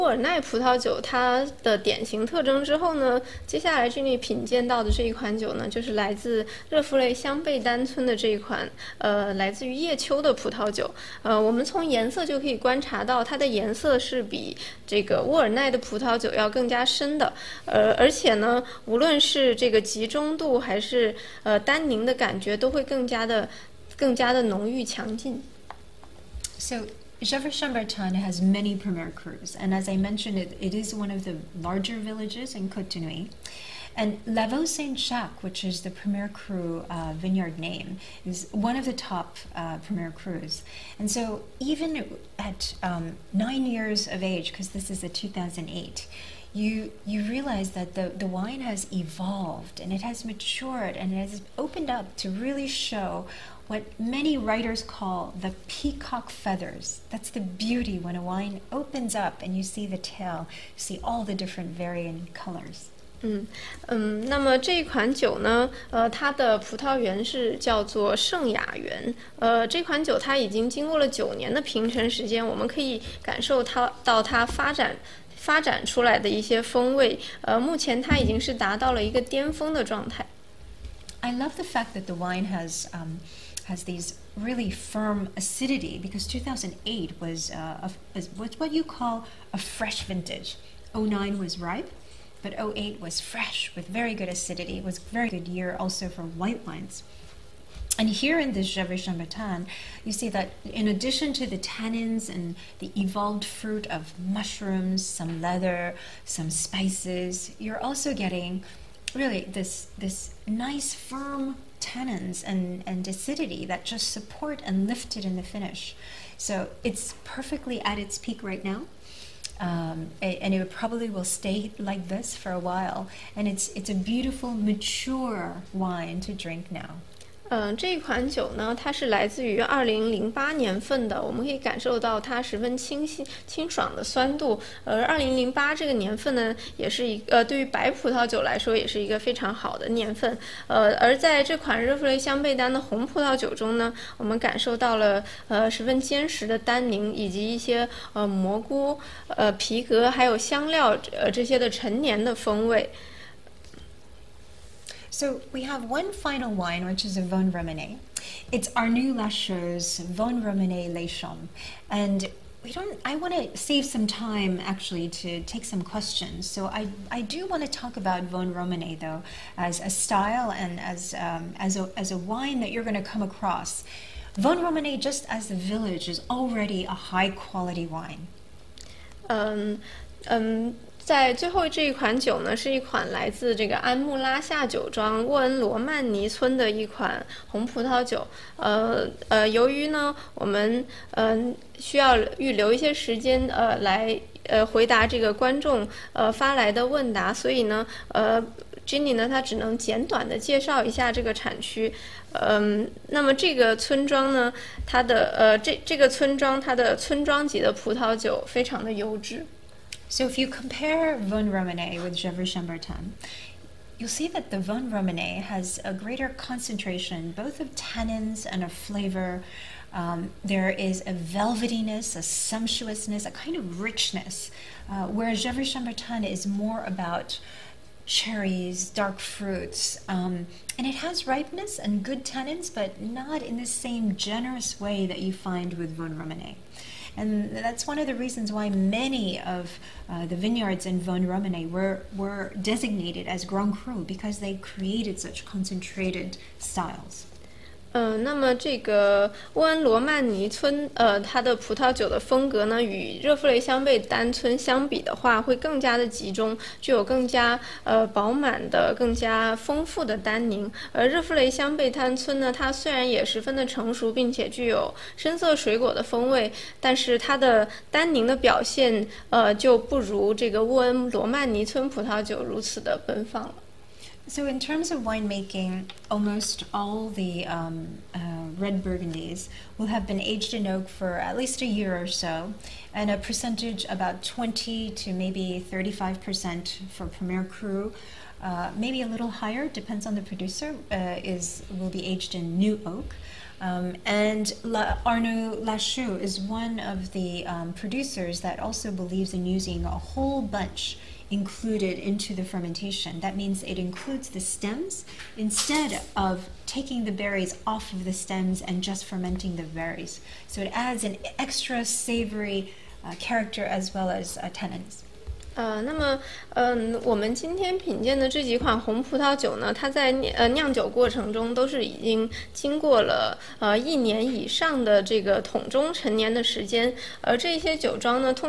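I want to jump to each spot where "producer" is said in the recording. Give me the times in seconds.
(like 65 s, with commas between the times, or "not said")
290 s, 297 s.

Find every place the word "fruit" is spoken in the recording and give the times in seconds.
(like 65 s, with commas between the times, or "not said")
103 s, 229 s.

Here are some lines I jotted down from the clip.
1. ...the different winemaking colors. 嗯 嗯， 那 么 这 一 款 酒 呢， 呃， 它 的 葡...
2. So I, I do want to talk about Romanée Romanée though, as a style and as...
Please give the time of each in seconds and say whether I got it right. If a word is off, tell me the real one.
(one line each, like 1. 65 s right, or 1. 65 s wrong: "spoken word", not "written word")
1. 61 s wrong: "varying", not "winemaking"
2. 166 s wrong: "Vosne", not "Romanée".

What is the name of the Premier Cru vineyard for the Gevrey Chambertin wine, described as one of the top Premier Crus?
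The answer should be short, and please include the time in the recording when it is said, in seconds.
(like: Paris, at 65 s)
Lavaux Saint-Jacques, at 34 s.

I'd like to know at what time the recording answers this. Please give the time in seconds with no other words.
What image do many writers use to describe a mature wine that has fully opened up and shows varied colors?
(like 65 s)
55 s.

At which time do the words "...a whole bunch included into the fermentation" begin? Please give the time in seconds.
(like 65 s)
299 s.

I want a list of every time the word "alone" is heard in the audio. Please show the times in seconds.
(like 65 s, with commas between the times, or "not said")
not said.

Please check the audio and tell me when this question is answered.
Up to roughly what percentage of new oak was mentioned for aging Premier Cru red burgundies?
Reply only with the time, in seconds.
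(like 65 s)
285 s.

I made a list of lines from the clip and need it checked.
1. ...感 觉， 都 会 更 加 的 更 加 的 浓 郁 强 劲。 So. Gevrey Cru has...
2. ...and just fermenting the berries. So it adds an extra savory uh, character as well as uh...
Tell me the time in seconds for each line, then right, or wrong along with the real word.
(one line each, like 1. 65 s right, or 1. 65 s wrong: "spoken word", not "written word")
1. 22 s wrong: "Chambertin", not "Cru"
2. 308 s right.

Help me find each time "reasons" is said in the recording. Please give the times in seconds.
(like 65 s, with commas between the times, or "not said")
238 s.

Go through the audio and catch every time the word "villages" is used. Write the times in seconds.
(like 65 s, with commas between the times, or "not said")
31 s, 175 s.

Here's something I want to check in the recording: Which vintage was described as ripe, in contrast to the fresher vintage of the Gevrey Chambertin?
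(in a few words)
2009.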